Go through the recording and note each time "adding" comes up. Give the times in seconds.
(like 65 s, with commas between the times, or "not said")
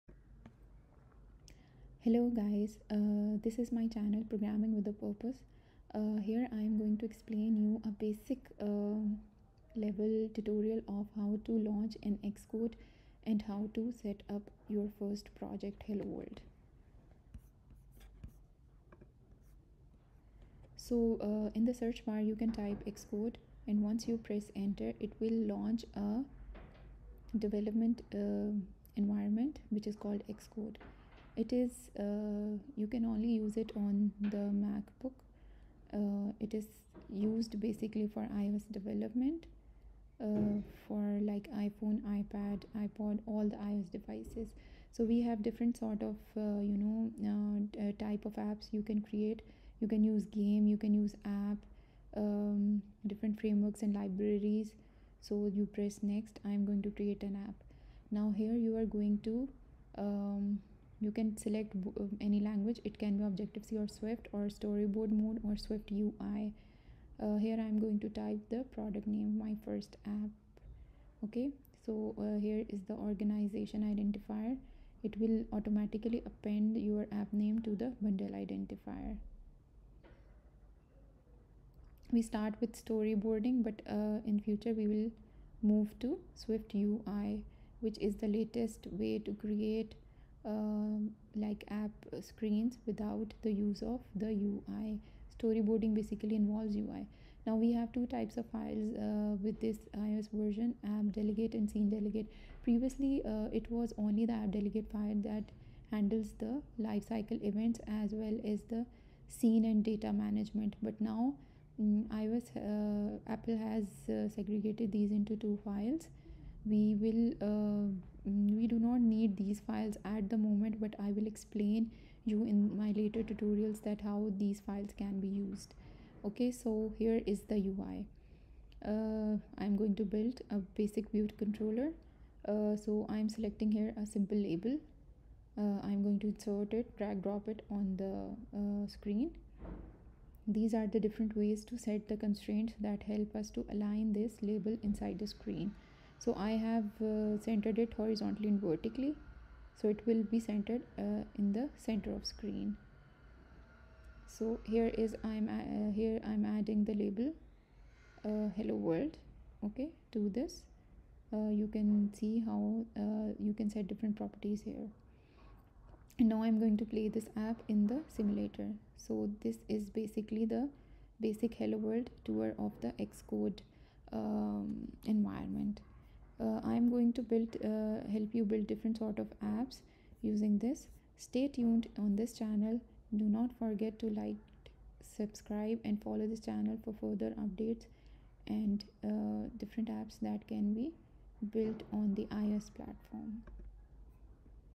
156 s.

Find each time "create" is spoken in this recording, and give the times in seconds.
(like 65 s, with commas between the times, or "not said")
49 s, 56 s, 89 s.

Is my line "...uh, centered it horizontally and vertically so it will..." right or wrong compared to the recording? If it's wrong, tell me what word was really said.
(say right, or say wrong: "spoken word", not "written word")
right.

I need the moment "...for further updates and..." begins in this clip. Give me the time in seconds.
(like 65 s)
186 s.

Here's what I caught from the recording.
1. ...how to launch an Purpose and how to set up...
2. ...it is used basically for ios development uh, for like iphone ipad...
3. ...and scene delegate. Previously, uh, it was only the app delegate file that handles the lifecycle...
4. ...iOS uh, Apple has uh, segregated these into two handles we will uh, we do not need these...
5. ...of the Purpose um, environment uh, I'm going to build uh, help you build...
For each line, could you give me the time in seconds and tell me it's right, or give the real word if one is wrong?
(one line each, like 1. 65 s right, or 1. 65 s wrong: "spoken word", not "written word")
1. 11 s wrong: "Xcode", not "Purpose"
2. 36 s right
3. 101 s right
4. 112 s wrong: "files", not "handles"
5. 172 s wrong: "Xcode", not "Purpose".